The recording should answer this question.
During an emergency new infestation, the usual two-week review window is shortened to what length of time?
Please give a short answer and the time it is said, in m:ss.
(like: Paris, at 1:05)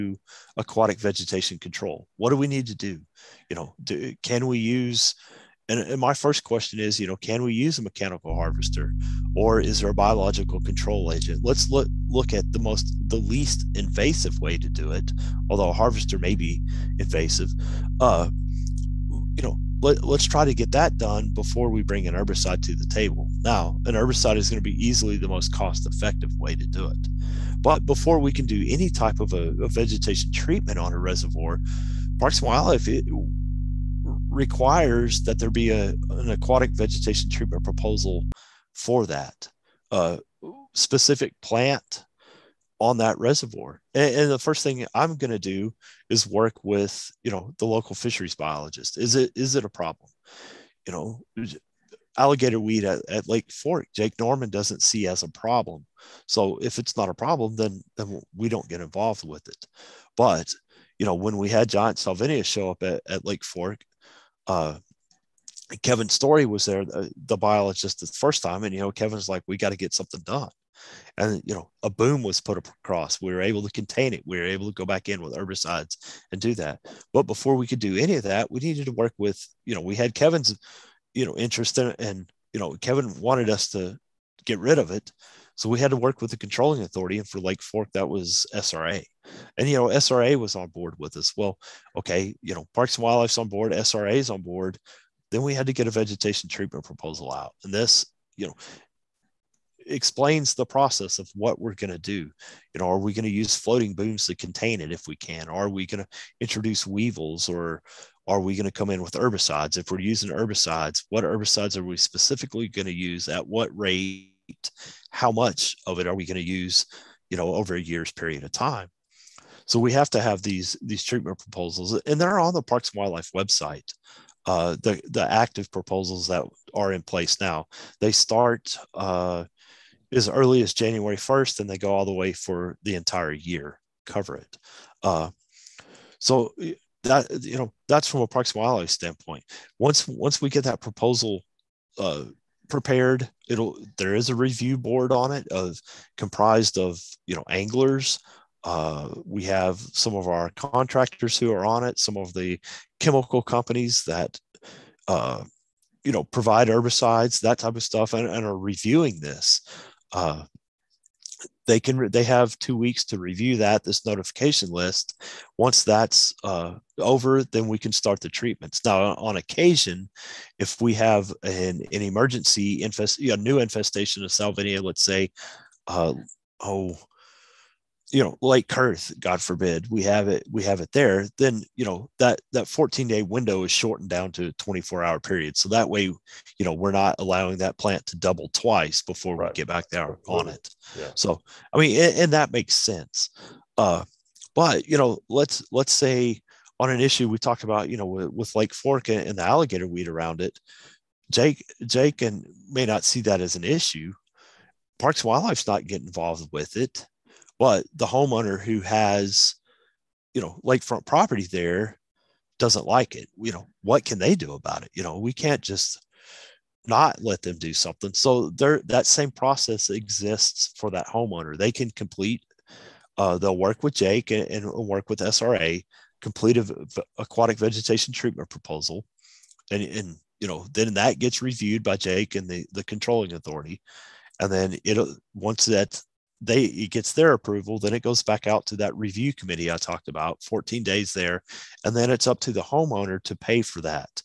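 24 hours, at 3:04.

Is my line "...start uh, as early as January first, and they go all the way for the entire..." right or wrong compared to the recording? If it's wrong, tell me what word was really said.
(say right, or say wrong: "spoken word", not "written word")
right.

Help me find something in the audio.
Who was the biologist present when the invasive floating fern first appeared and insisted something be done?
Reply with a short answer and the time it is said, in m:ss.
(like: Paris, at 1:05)
Kevin Storey, at 1:05.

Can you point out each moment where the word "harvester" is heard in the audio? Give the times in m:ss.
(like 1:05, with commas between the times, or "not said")
0:08, 0:15.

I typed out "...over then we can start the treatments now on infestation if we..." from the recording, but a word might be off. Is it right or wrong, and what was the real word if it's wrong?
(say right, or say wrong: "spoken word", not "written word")
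wrong: "occasion", not "infestation".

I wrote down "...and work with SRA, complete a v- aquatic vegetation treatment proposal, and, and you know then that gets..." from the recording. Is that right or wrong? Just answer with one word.
right.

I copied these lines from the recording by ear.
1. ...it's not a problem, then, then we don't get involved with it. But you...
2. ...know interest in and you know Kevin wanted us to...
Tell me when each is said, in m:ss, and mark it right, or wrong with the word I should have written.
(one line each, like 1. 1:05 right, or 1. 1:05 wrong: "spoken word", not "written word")
1. 0:56 right
2. 1:21 right.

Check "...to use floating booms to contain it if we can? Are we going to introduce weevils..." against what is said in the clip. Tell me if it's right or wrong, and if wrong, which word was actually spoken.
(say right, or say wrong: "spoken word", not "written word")
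right.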